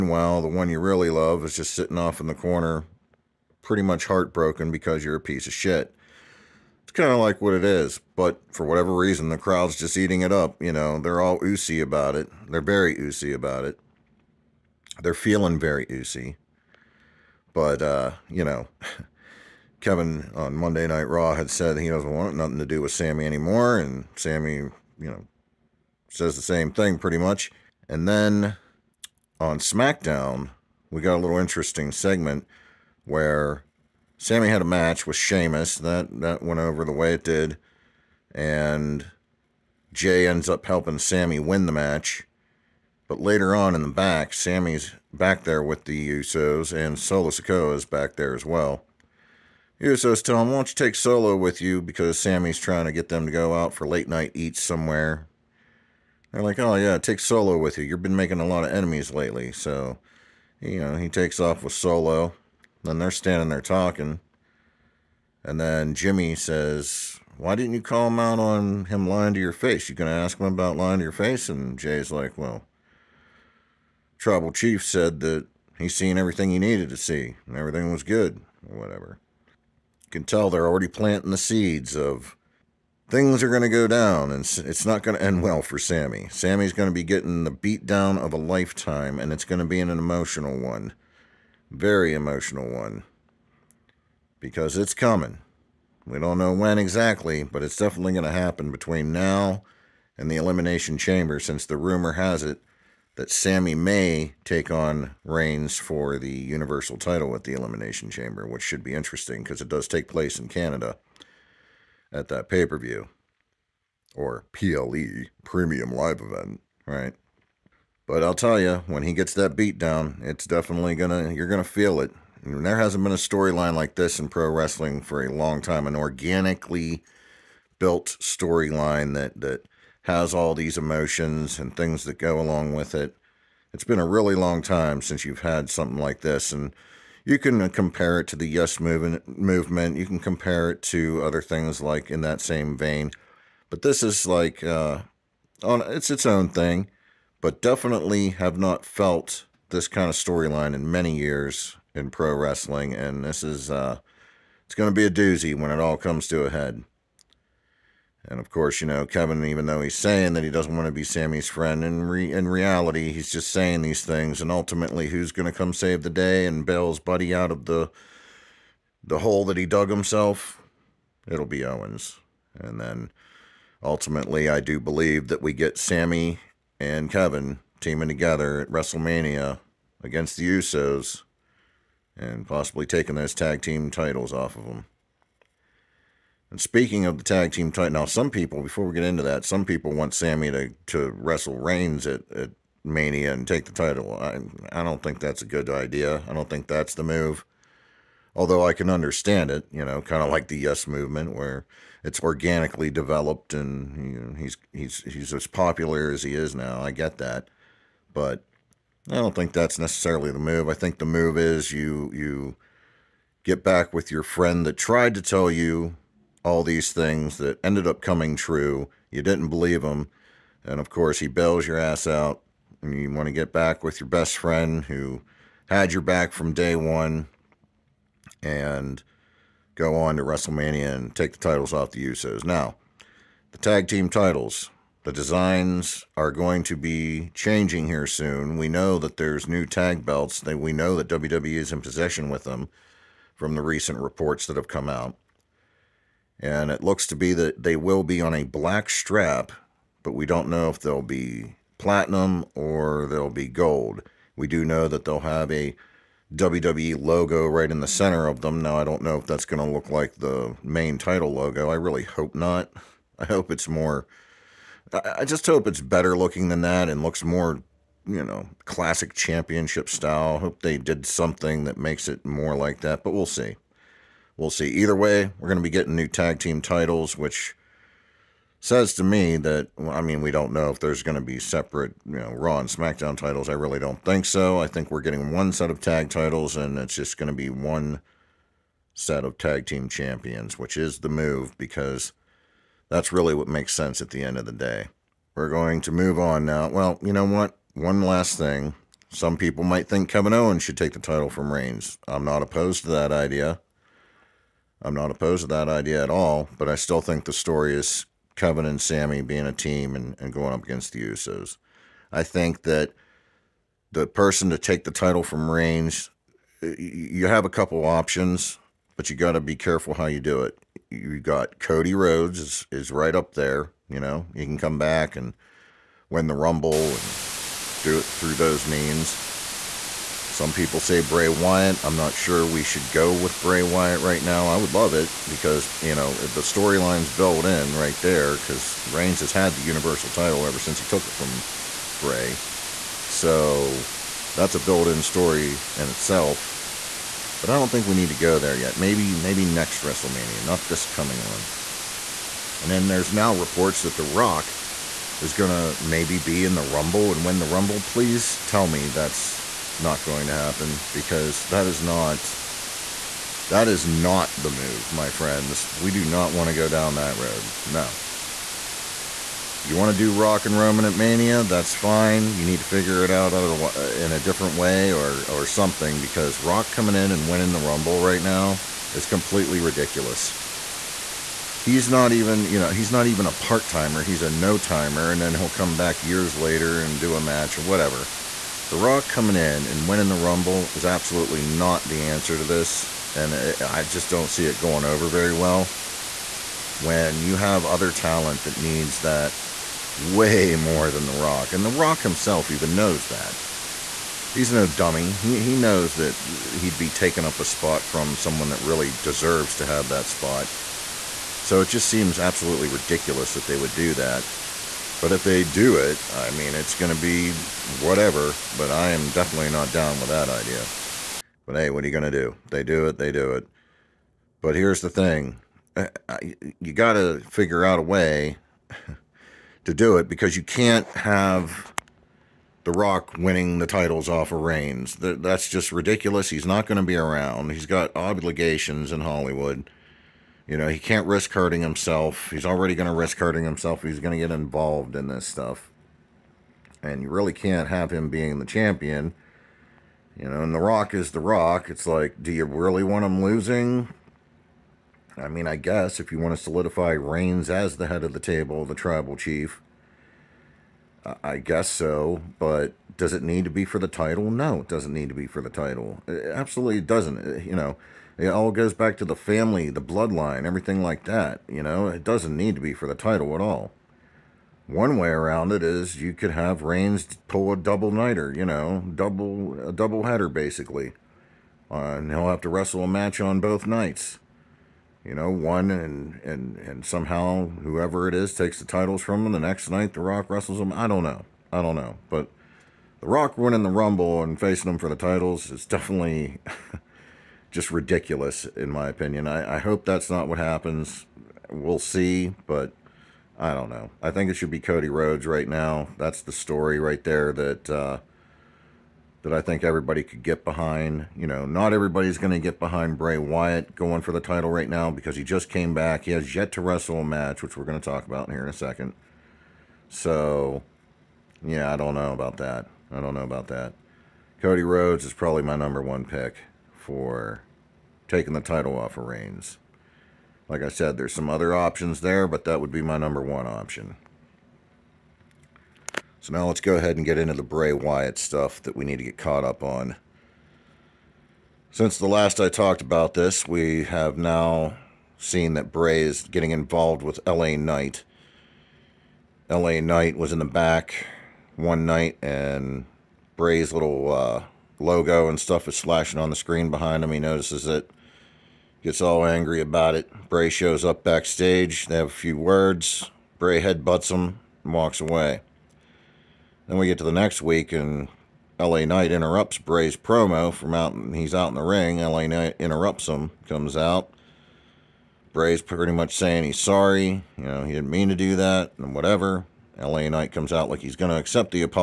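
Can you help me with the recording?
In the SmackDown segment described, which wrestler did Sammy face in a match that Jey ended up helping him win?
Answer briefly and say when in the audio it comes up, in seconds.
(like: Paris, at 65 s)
Sheamus, at 35 s.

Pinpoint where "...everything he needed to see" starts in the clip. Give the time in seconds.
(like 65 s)
76 s.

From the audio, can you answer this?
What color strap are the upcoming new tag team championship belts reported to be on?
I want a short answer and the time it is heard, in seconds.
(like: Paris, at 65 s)
Black, at 248 s.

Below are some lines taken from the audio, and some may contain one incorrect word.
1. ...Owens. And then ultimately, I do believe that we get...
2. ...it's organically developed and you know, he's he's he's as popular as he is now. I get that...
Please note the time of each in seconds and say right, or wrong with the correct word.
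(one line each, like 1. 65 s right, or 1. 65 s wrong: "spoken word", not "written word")
1. 171 s right
2. 202 s right.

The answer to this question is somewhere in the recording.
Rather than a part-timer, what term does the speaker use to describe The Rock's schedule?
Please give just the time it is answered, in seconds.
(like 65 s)
384 s.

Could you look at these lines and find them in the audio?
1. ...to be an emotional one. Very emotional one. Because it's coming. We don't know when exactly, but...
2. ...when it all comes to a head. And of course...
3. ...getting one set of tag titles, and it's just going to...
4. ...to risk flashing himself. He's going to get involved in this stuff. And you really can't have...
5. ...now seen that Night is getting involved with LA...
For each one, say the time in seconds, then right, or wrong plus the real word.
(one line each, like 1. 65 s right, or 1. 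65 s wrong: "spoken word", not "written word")
1. 89 s right
2. 155 s right
3. 285 s right
4. 442 s wrong: "hurting", not "flashing"
5. 544 s wrong: "Bray", not "Night".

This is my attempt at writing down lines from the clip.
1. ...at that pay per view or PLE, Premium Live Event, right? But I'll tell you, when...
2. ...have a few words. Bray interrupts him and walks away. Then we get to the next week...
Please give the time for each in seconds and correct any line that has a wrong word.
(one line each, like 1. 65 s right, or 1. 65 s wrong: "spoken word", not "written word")
1. 112 s right
2. 561 s wrong: "headbutts", not "interrupts".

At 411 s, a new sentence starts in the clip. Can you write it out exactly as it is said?
So it just seems absolutely ridiculous that they would do that.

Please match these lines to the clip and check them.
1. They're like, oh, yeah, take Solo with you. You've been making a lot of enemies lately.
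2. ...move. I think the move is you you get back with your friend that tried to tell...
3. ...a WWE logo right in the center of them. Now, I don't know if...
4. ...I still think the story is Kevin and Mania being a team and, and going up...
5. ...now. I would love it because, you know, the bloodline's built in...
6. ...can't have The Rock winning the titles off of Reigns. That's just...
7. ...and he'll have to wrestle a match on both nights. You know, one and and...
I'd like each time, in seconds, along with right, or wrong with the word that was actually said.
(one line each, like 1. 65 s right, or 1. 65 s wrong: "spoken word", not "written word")
1. 56 s right
2. 210 s right
3. 255 s right
4. 306 s wrong: "Sammy", not "Mania"
5. 334 s wrong: "storyline", not "bloodline"
6. 430 s right
7. 481 s right.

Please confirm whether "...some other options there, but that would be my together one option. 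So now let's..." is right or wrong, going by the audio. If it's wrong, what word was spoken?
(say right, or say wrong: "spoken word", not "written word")
wrong: "number", not "together".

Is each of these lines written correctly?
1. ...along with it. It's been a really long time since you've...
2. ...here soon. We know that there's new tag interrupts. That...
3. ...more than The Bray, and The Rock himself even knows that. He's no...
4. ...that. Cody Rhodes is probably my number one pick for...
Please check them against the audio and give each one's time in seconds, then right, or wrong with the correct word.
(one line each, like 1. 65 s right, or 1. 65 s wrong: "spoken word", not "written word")
1. 132 s right
2. 237 s wrong: "belts", not "interrupts"
3. 400 s wrong: "Rock", not "Bray"
4. 523 s right.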